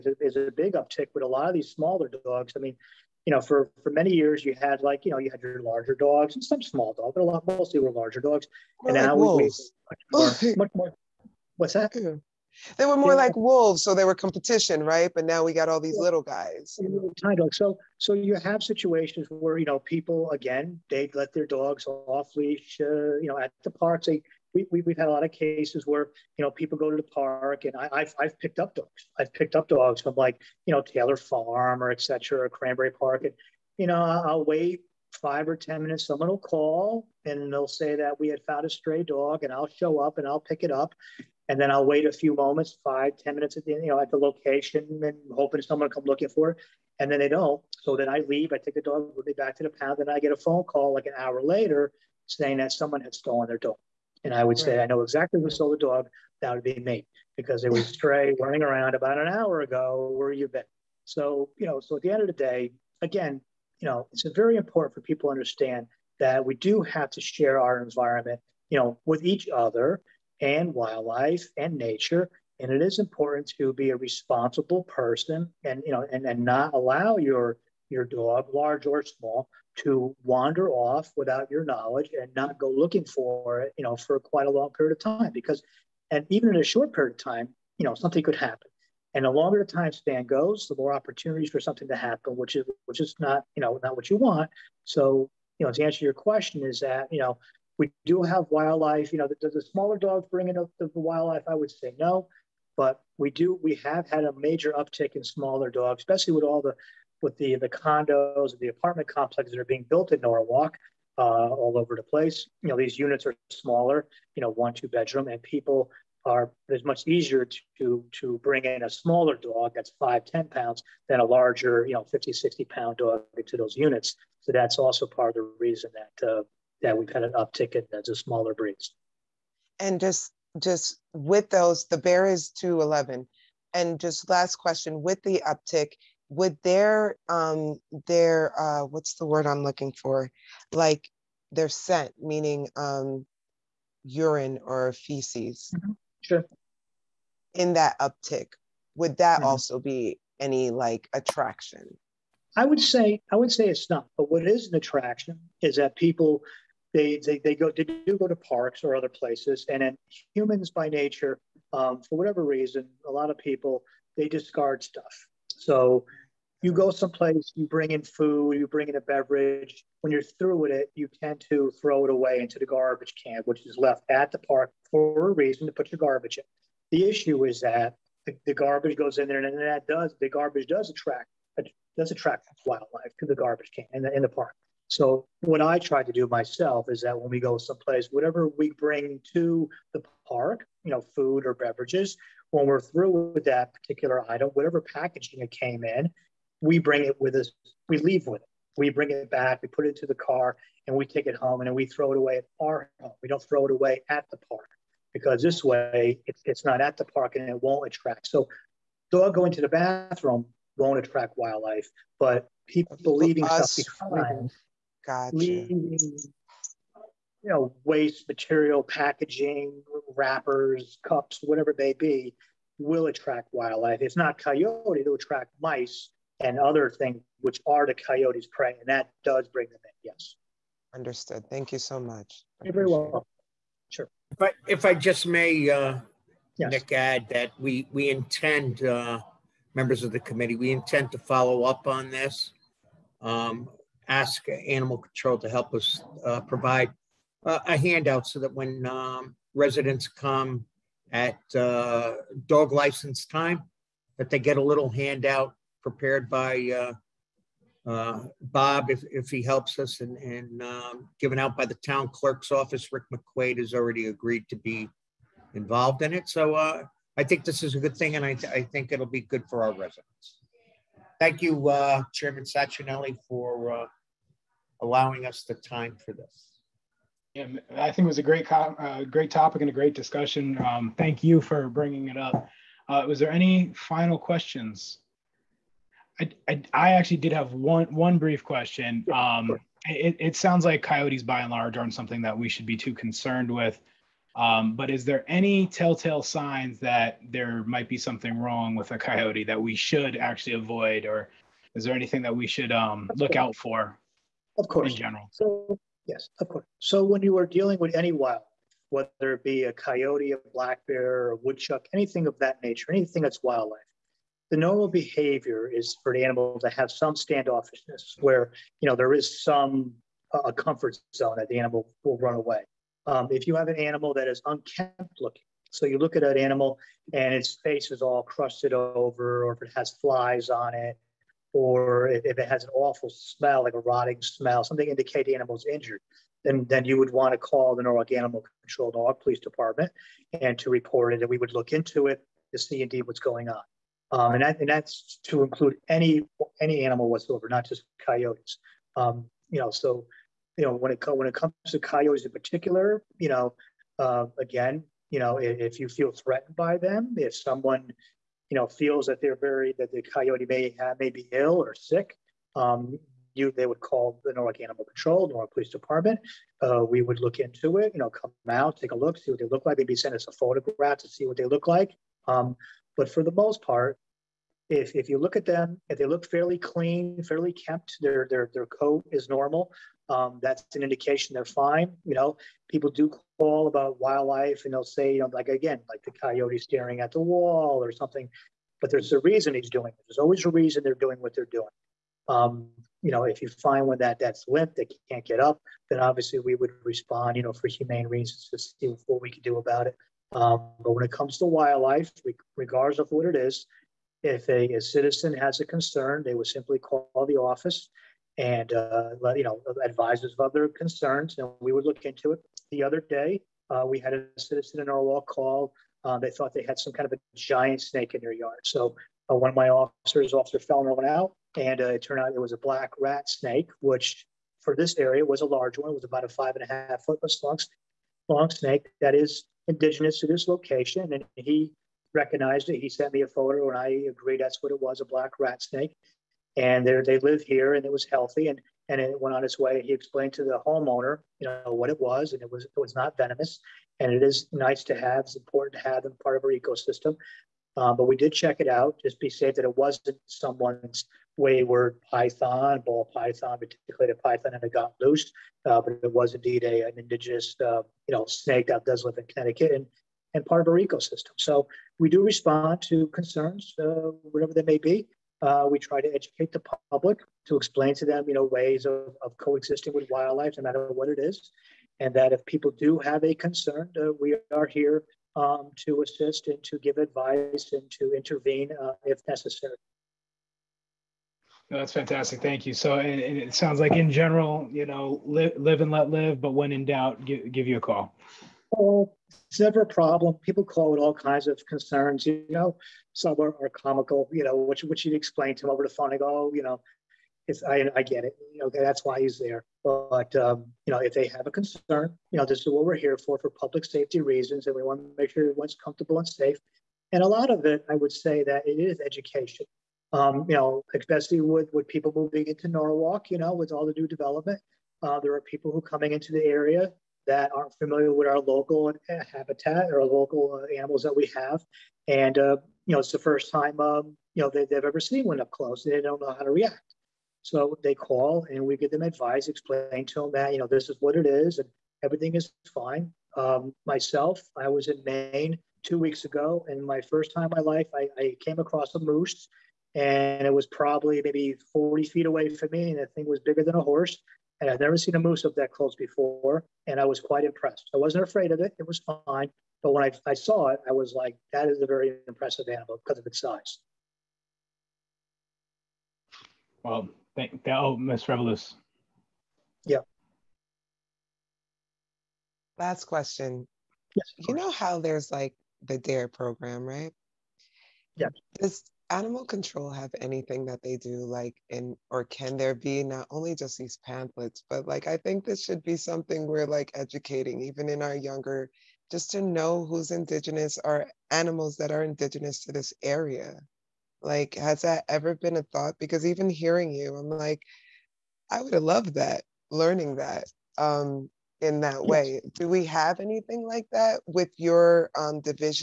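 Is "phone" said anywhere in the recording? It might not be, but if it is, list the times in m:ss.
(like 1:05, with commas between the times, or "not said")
0:50, 8:15.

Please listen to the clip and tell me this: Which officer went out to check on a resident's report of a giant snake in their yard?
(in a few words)
Officer Fellner.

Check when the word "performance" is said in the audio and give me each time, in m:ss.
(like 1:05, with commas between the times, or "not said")
not said.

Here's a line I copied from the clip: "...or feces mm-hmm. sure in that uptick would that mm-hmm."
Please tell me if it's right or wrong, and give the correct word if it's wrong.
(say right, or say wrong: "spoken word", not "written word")
right.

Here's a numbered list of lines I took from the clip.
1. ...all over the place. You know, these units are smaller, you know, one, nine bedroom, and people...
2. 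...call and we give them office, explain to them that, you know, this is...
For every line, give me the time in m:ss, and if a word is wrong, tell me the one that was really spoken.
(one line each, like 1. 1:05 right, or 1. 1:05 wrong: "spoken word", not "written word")
1. 1:51 wrong: "two", not "nine"
2. 8:47 wrong: "advice", not "office".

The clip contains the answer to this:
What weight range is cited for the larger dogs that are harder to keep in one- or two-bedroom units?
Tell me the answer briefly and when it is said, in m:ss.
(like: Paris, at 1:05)
50 to 60 pounds, at 2:02.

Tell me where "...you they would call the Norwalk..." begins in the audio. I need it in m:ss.
6:03.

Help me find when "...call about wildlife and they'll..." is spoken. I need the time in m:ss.
6:23.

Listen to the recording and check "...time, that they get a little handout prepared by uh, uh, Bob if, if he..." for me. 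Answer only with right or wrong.
right.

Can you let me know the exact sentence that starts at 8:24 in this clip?
And we want to make sure everyone's comfortable and safe.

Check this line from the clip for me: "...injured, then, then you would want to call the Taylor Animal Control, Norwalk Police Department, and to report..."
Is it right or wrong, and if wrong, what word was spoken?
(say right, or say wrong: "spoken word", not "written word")
wrong: "Norwalk", not "Taylor".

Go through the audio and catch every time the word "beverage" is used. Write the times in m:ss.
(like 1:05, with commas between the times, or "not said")
2:49, 3:11.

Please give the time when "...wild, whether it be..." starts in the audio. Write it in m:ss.
5:08.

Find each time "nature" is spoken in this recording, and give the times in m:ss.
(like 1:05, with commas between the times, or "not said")
1:11, 2:40, 5:12.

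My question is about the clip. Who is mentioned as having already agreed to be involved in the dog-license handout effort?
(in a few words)
Rick McQuaid.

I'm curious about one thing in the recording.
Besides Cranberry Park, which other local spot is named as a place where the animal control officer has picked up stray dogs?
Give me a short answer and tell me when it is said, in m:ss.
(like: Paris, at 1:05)
Taylor Farm, at 0:30.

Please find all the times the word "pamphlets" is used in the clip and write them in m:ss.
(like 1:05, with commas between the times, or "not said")
9:34.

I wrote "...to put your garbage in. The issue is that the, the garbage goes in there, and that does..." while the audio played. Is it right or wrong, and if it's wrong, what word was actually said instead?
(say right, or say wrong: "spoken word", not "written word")
right.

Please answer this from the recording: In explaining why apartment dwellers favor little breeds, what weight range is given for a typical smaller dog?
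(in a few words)
5 to 10 pounds.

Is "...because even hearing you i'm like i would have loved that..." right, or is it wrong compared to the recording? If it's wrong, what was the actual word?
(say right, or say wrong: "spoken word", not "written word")
right.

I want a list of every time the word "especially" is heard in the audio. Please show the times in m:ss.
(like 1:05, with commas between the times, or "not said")
1:46, 8:30.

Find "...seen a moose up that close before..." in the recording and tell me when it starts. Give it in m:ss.
9:04.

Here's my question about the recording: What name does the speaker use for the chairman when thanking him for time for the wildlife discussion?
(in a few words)
Chairman Sachinelli.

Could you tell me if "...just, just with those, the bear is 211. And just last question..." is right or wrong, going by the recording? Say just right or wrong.
right.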